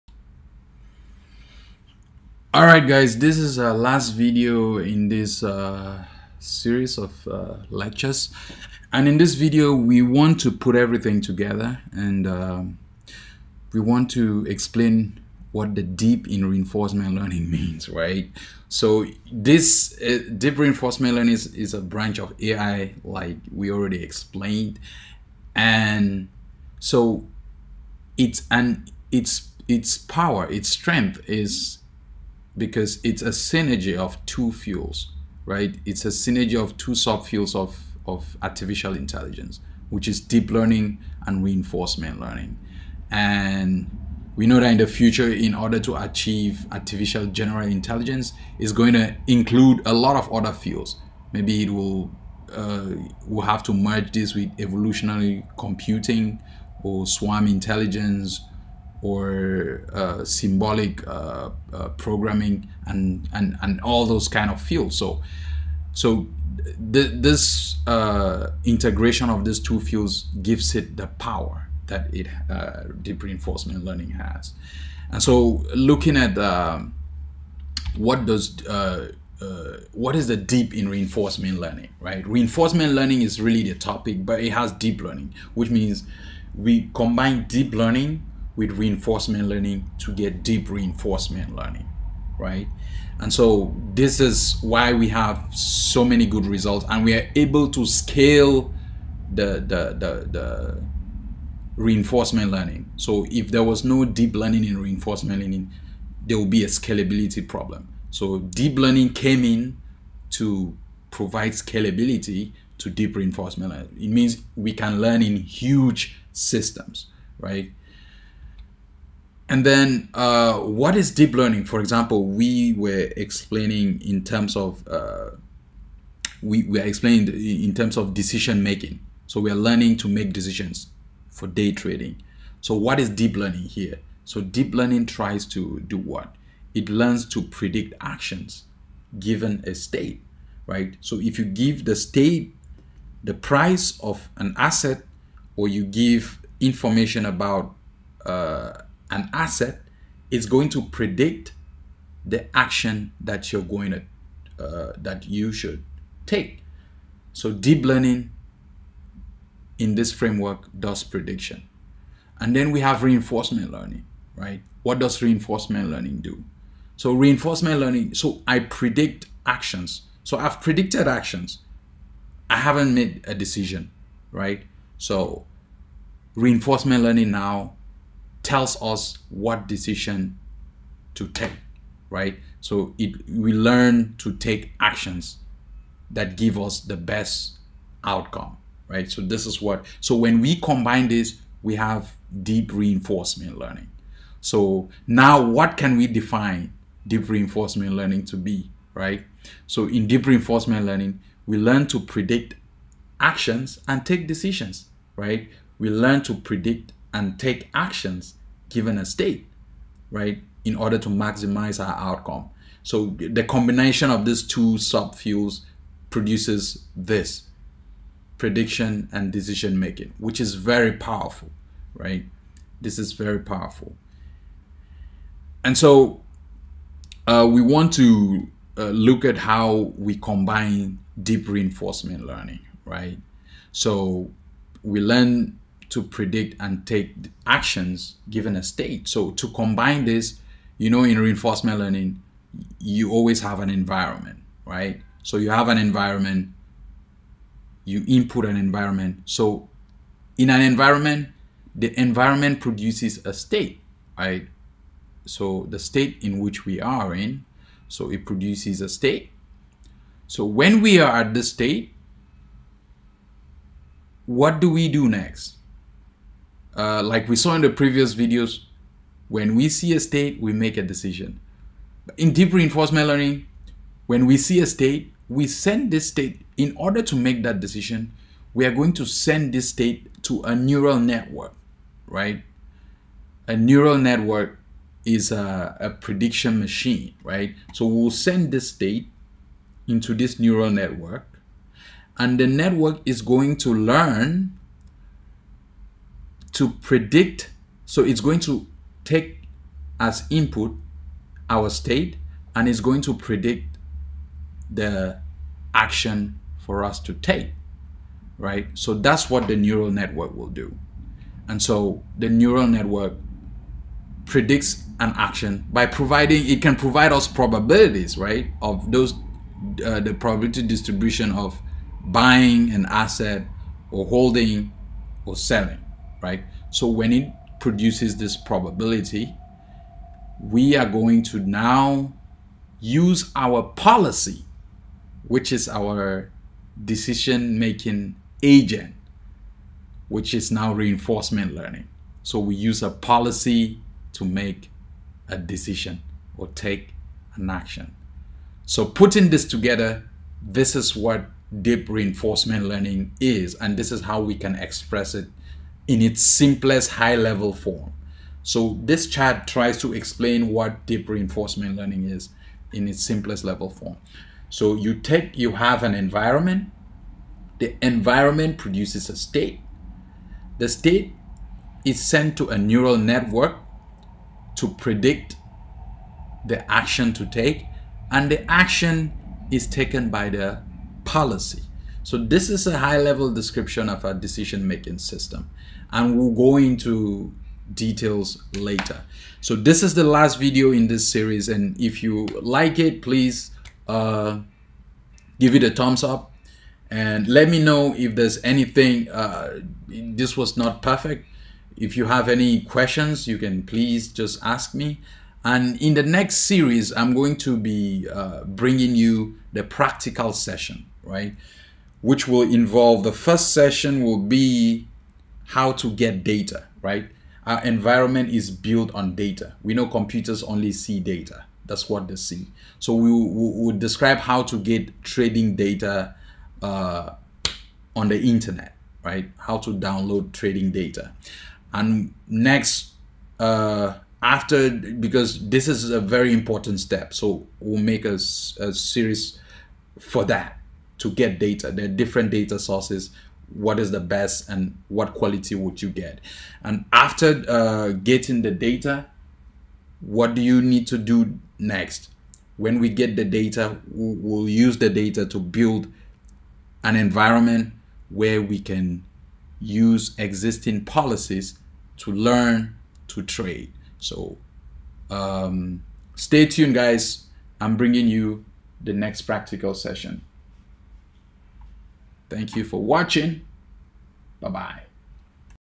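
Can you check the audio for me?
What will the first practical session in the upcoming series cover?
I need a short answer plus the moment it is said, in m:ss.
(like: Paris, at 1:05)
How to get data, at 6:55.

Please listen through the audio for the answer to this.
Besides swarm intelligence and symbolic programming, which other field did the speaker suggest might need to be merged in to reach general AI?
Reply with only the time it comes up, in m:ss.
0:54.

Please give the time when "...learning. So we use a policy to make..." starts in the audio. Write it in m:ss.
5:41.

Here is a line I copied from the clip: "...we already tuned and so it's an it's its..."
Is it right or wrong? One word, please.
wrong.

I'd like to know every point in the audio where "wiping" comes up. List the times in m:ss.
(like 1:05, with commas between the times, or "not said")
not said.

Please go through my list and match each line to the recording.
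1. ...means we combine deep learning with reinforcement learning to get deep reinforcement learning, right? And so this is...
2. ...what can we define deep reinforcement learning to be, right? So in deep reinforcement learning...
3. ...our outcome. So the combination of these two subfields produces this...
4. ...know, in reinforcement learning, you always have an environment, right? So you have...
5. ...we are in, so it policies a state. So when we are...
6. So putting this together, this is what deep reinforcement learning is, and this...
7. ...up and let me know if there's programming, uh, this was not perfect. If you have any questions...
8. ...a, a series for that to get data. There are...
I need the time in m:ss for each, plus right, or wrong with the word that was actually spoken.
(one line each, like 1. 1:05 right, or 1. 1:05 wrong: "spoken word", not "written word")
1. 1:25 right
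2. 3:15 right
3. 3:31 right
4. 4:00 right
5. 4:16 wrong: "produces", not "policies"
6. 5:48 right
7. 6:36 wrong: "anything", not "programming"
8. 7:18 right.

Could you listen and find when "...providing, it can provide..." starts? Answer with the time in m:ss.
5:15.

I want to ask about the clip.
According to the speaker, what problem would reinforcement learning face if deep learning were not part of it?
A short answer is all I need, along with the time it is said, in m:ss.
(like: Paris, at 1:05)
Scalability problem, at 1:46.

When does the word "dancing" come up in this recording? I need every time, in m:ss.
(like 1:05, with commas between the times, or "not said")
not said.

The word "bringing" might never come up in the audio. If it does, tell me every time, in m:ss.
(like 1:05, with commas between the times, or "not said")
6:48, 7:47.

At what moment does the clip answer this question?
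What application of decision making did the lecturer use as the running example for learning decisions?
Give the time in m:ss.
2:11.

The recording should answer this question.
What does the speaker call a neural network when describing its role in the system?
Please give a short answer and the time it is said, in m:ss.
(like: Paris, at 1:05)
A prediction machine, at 4:45.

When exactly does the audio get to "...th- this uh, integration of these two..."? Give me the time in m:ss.
1:06.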